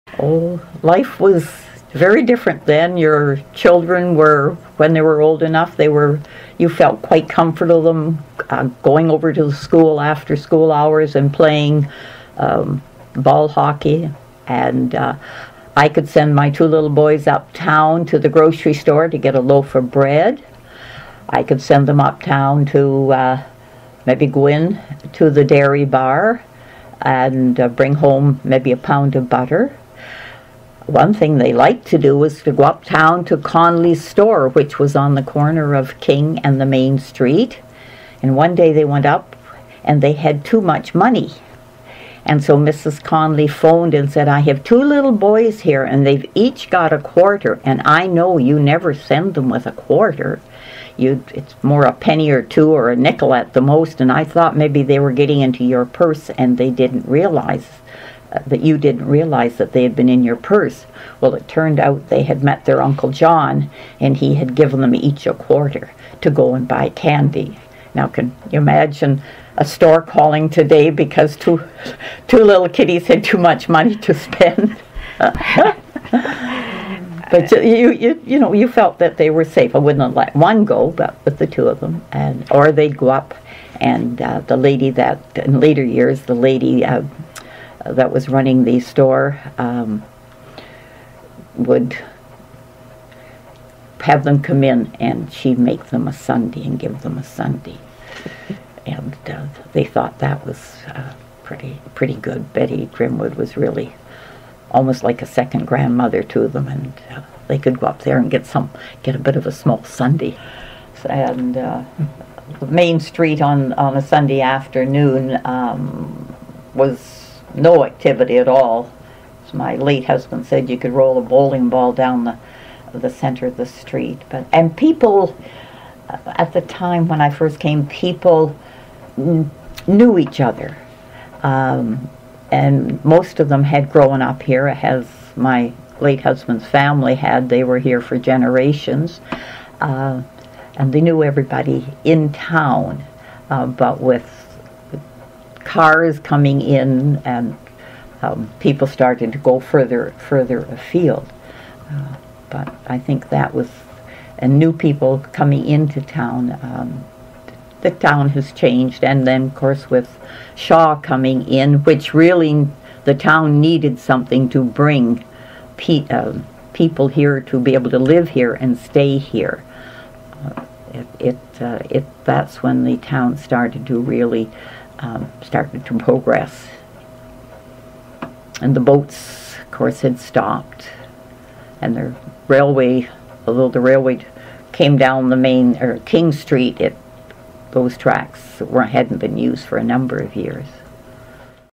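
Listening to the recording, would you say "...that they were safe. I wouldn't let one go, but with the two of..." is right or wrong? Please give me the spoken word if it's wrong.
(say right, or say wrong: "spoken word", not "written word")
right.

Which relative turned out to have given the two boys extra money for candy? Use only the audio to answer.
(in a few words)
Uncle John.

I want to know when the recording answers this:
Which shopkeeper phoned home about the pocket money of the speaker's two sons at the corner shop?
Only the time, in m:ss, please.
0:42.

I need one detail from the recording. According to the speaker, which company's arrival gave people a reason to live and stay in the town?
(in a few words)
Shaw.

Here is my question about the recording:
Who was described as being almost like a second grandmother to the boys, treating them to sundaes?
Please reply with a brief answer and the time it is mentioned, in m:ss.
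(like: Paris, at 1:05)
Betty Grimwood, at 1:42.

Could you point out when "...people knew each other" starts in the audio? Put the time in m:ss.
2:07.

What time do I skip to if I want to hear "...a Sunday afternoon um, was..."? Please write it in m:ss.
1:53.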